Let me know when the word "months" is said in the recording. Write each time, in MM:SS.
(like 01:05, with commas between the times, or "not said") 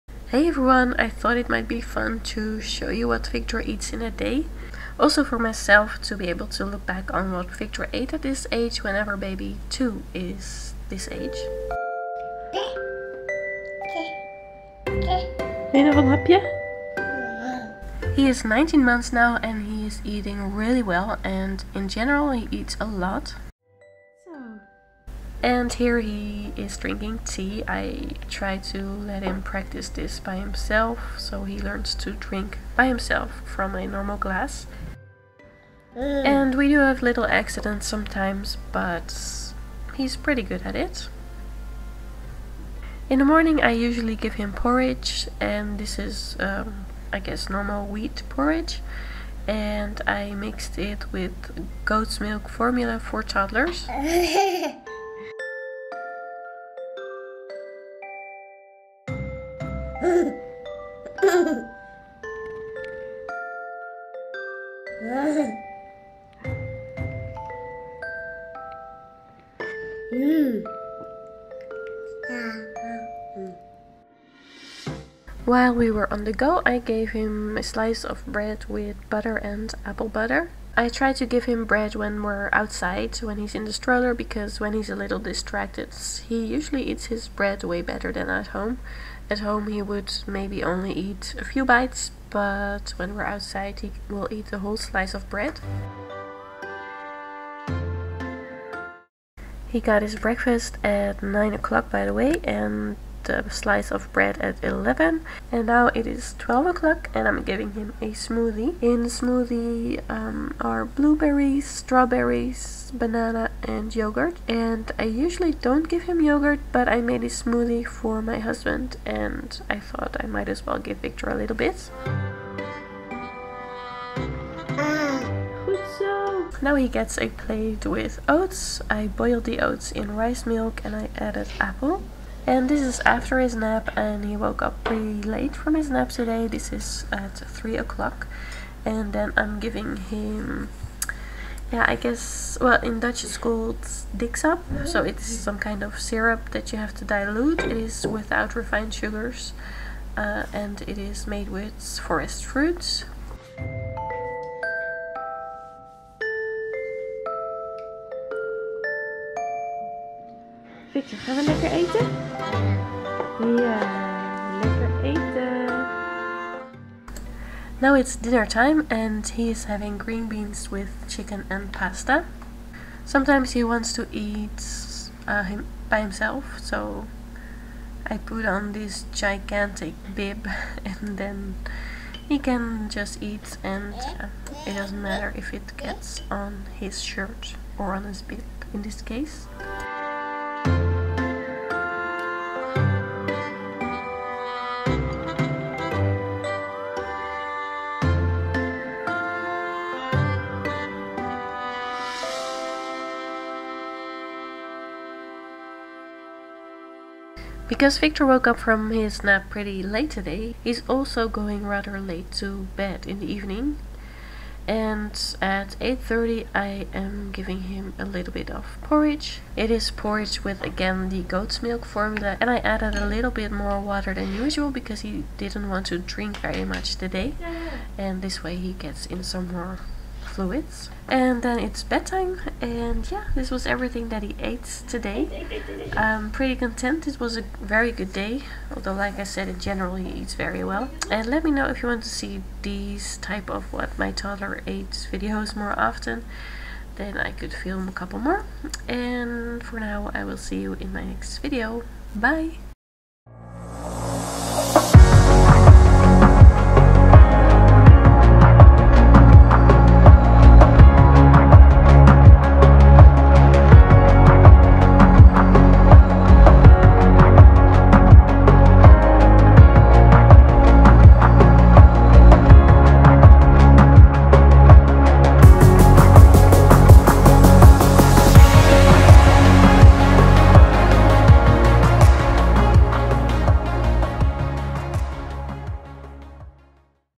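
00:18.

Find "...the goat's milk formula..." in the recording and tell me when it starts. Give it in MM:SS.
03:41.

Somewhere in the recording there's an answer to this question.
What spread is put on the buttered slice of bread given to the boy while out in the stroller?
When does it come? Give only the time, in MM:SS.
01:19.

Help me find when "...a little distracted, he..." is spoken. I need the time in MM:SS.
01:24.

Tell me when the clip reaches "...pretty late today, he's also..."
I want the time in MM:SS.
03:29.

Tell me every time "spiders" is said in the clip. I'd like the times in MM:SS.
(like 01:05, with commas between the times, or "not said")
not said.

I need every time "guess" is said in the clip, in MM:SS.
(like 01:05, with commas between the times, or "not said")
00:47, 02:21.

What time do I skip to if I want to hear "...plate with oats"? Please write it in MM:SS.
02:07.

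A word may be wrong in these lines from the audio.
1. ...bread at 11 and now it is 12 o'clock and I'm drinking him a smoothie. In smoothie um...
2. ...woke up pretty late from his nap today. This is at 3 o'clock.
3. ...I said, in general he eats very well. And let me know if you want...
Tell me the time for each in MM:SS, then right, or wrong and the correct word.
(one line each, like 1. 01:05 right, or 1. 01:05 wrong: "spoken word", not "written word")
1. 01:44 wrong: "giving", not "drinking"
2. 02:14 right
3. 03:59 right.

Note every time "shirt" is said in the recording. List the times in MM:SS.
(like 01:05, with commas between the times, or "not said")
03:07.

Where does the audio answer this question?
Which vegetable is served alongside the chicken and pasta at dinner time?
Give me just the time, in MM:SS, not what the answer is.
02:50.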